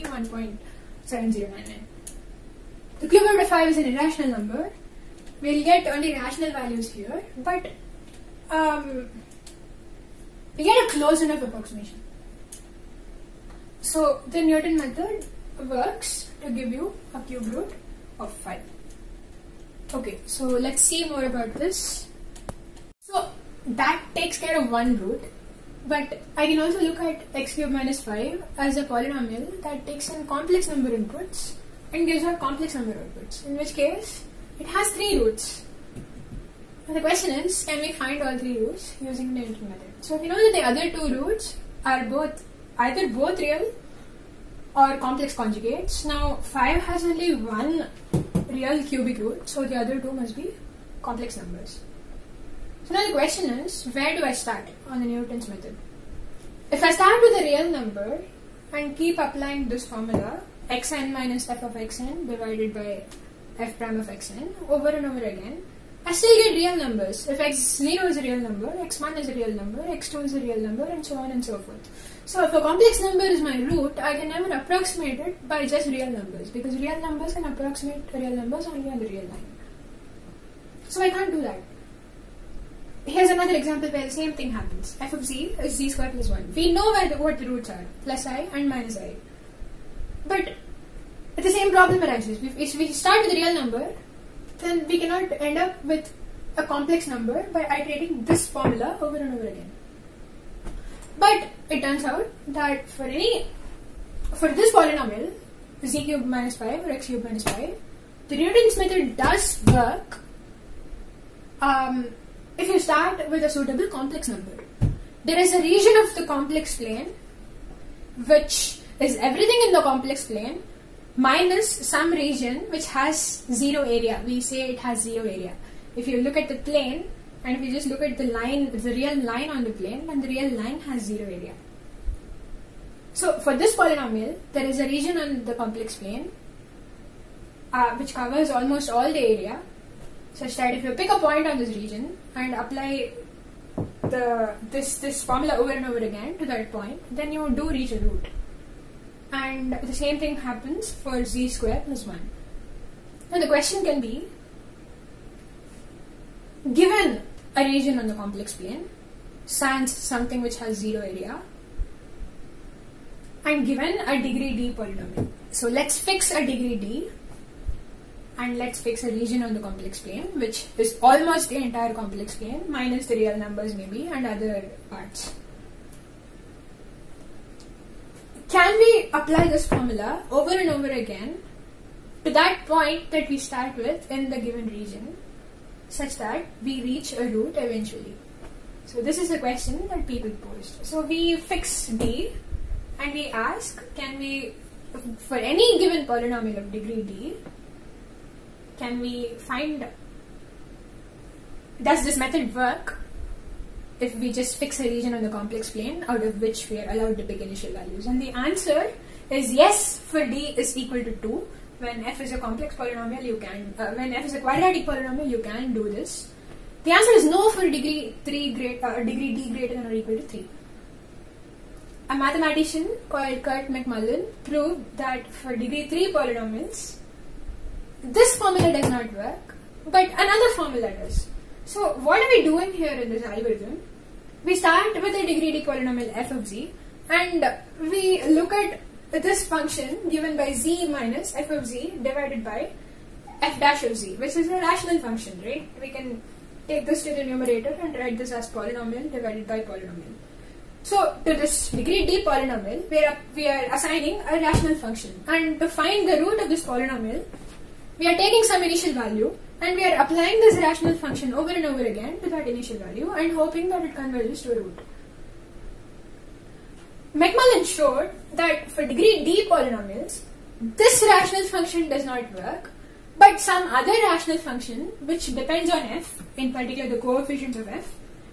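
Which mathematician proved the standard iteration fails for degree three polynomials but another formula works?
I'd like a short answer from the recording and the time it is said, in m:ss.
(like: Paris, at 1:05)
Curt McMullen, at 3:43.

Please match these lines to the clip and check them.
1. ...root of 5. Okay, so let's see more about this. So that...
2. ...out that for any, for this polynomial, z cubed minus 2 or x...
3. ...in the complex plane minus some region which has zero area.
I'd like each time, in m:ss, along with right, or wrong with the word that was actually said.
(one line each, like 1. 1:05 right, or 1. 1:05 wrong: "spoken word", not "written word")
1. 0:17 right
2. 1:42 wrong: "5", not "2"
3. 1:59 right.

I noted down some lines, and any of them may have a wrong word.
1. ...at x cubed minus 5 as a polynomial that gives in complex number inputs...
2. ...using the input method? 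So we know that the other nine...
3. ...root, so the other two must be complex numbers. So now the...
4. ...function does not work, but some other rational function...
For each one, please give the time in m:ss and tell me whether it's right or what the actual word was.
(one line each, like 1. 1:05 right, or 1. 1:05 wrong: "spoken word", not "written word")
1. 0:26 wrong: "takes", not "gives"
2. 0:39 wrong: "two", not "nine"
3. 0:49 right
4. 4:31 right.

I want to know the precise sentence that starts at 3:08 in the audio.
So this is a question that people posed.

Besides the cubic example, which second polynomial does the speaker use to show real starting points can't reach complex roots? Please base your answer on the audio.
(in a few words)
z squared plus 1.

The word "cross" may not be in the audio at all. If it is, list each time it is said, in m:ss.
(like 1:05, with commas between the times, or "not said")
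not said.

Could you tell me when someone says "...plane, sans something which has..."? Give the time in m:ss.
2:38.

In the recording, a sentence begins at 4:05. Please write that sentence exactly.
We can take this to the numerator and write this as polynomial divided by polynomial.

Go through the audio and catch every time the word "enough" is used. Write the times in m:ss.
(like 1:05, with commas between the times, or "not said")
0:11.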